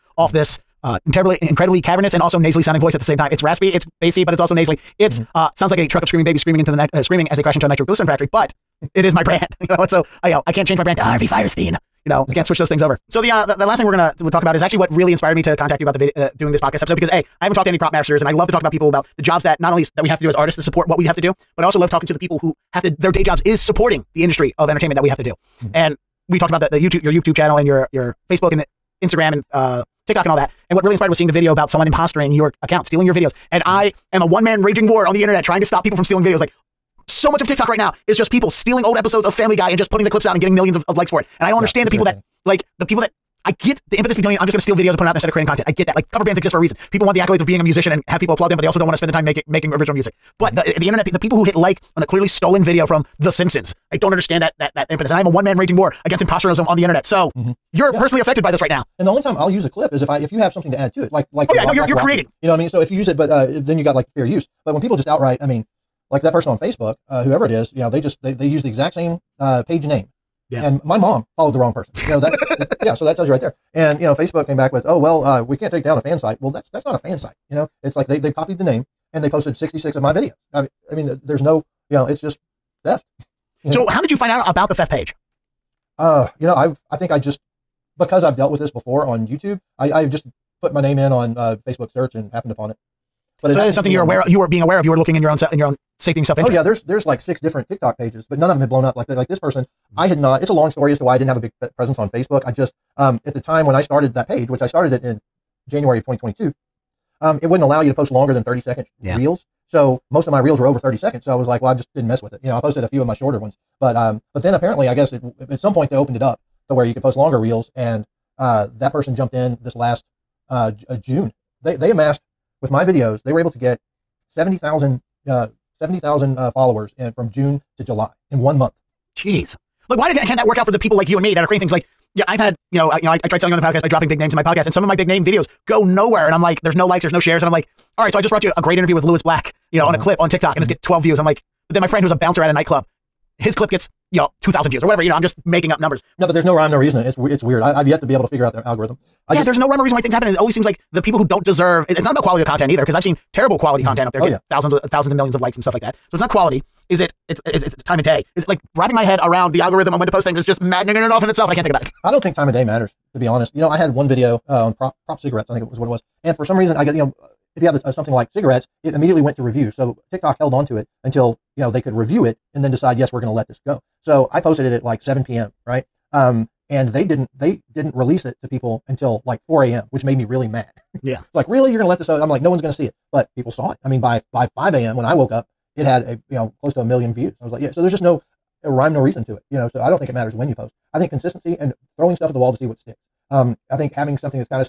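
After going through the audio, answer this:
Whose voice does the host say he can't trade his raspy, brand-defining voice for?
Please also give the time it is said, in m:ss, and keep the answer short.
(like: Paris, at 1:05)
Harvey Fierstein, at 0:11.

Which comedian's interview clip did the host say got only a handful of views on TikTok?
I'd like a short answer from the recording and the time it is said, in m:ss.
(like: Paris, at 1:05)
Lewis Black, at 2:19.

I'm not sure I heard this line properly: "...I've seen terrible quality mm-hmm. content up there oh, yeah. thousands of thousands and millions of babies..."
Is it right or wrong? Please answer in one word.
wrong.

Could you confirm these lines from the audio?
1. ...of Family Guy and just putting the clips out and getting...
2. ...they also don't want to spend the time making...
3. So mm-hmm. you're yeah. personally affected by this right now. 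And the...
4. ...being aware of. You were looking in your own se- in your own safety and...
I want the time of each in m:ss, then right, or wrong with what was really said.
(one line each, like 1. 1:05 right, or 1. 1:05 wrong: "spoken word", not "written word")
1. 0:39 right
2. 0:48 right
3. 0:57 right
4. 1:34 right.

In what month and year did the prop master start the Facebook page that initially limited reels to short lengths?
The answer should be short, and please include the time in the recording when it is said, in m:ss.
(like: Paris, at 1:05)
January 2022, at 1:45.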